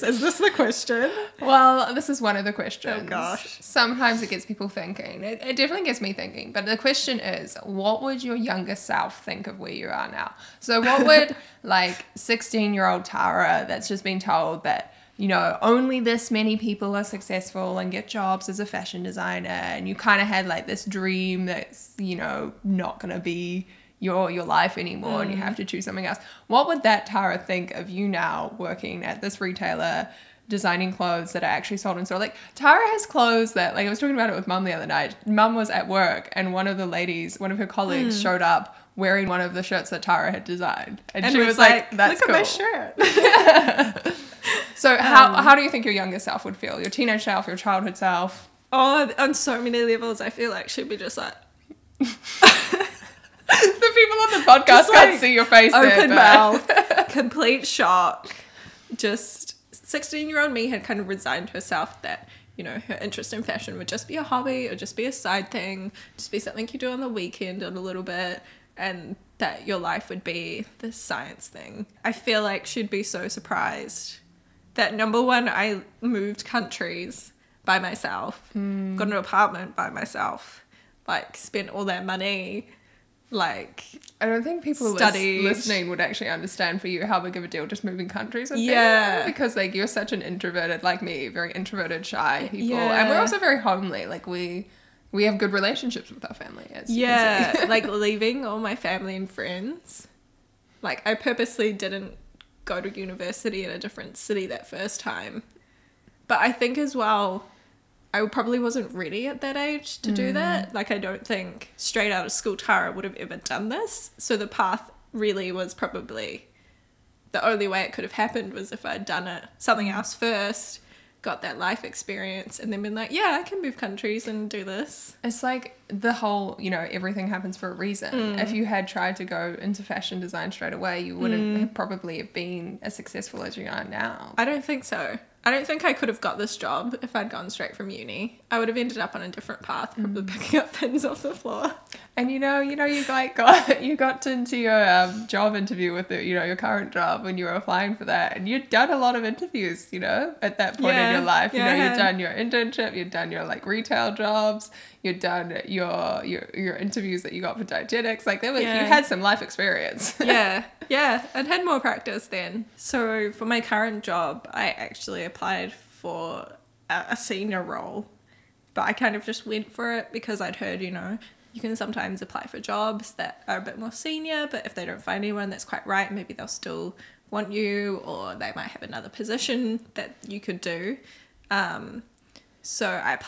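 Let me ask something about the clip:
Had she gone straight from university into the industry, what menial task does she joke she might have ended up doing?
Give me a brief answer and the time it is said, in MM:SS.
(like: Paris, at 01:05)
Picking up pens off the floor, at 02:20.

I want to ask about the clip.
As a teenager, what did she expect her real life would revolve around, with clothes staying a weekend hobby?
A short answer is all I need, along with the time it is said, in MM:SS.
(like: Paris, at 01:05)
The science thing, at 01:10.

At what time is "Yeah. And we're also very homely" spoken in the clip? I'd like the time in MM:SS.
01:32.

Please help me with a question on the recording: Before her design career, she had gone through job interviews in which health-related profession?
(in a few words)
Dietetics.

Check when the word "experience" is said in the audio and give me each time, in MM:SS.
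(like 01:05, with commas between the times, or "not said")
02:01, 02:39.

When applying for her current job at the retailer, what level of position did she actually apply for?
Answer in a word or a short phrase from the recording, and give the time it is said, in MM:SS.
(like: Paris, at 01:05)
Senior role, at 02:47.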